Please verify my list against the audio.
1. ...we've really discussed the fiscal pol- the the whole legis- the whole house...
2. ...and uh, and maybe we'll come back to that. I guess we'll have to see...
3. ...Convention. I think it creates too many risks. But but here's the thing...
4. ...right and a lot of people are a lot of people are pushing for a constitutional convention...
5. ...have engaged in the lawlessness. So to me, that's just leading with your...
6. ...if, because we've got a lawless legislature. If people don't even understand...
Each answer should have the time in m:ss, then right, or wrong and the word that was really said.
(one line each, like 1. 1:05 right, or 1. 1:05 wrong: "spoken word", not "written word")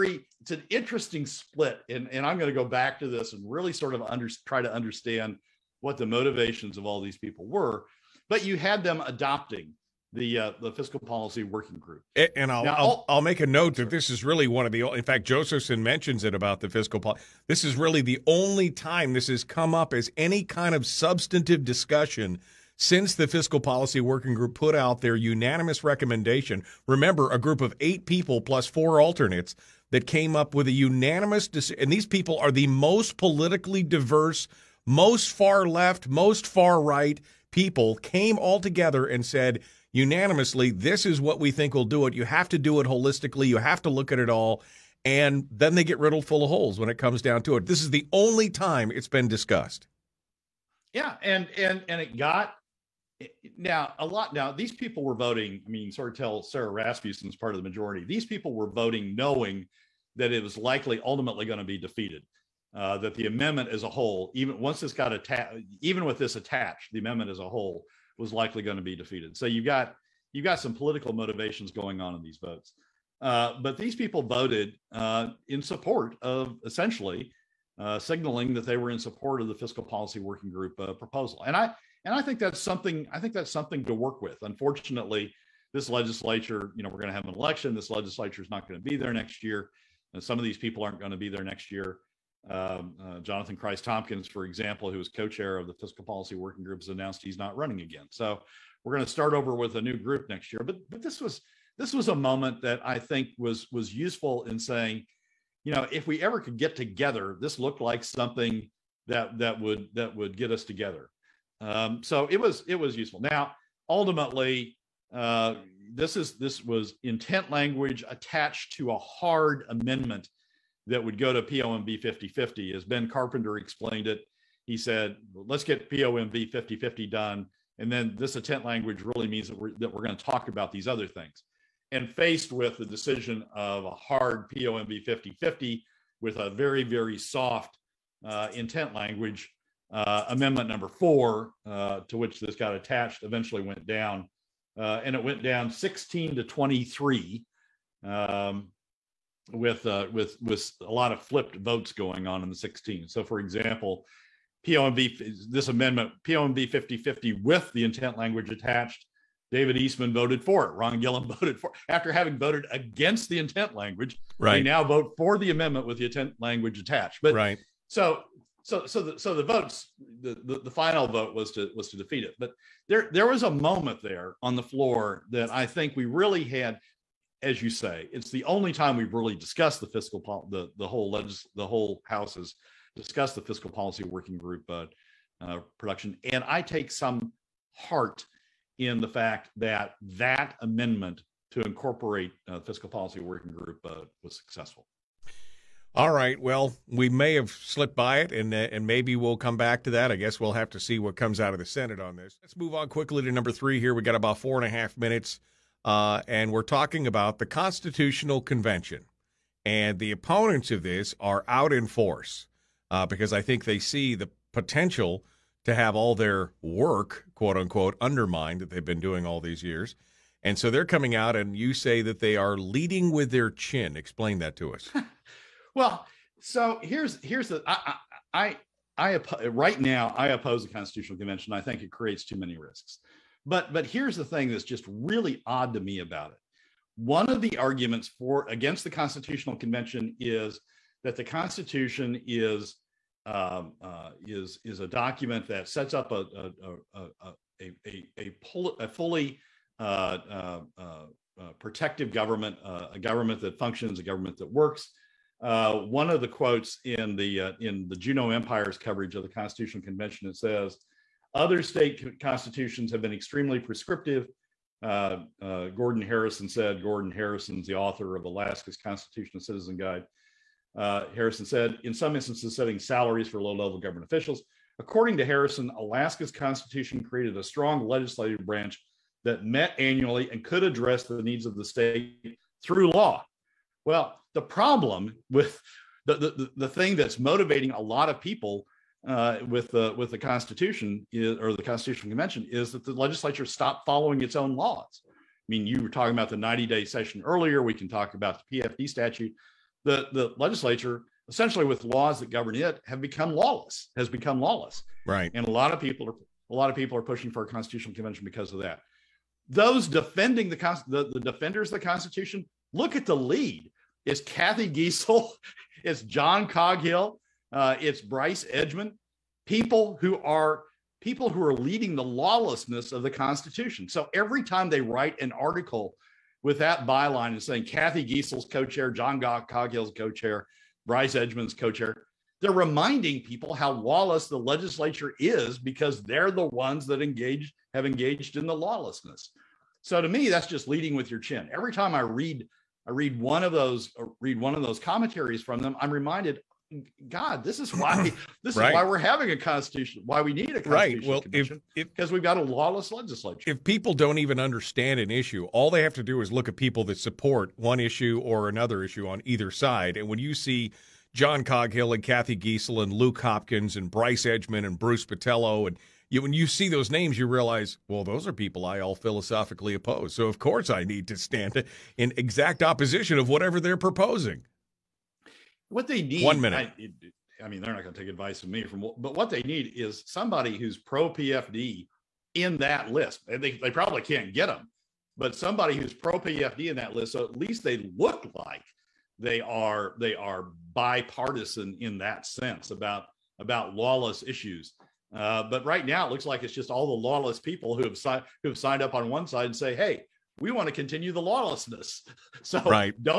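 1. 2:58 right
2. 3:18 right
3. 3:51 right
4. 5:05 right
5. 5:37 right
6. 5:51 right.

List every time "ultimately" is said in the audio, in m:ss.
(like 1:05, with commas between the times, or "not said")
1:01, 1:53.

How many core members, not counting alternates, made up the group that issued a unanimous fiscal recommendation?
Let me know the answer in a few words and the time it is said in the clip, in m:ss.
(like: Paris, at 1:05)
8, at 0:27.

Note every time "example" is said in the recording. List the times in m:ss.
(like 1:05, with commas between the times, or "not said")
1:34, 2:33.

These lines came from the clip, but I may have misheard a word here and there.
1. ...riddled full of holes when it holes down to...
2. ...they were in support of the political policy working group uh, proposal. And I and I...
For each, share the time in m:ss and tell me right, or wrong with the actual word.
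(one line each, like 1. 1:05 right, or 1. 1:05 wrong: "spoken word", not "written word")
1. 0:45 wrong: "comes", not "holes"
2. 1:18 wrong: "fiscal", not "political".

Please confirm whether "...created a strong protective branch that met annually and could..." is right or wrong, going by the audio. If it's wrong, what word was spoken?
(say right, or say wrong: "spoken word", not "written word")
wrong: "legislative", not "protective".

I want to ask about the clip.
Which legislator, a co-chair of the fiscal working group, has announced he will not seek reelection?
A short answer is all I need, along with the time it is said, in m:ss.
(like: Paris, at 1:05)
Jonathan Kreiss-Tomkins, at 1:33.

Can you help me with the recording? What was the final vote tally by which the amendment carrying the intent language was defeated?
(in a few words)
16 to 23.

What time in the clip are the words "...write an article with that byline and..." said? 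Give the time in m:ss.
5:24.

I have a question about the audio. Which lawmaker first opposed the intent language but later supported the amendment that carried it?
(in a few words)
Ron Gillham.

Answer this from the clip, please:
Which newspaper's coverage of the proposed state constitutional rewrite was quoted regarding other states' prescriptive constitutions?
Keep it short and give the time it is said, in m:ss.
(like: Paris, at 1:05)
Juneau Empire, at 4:17.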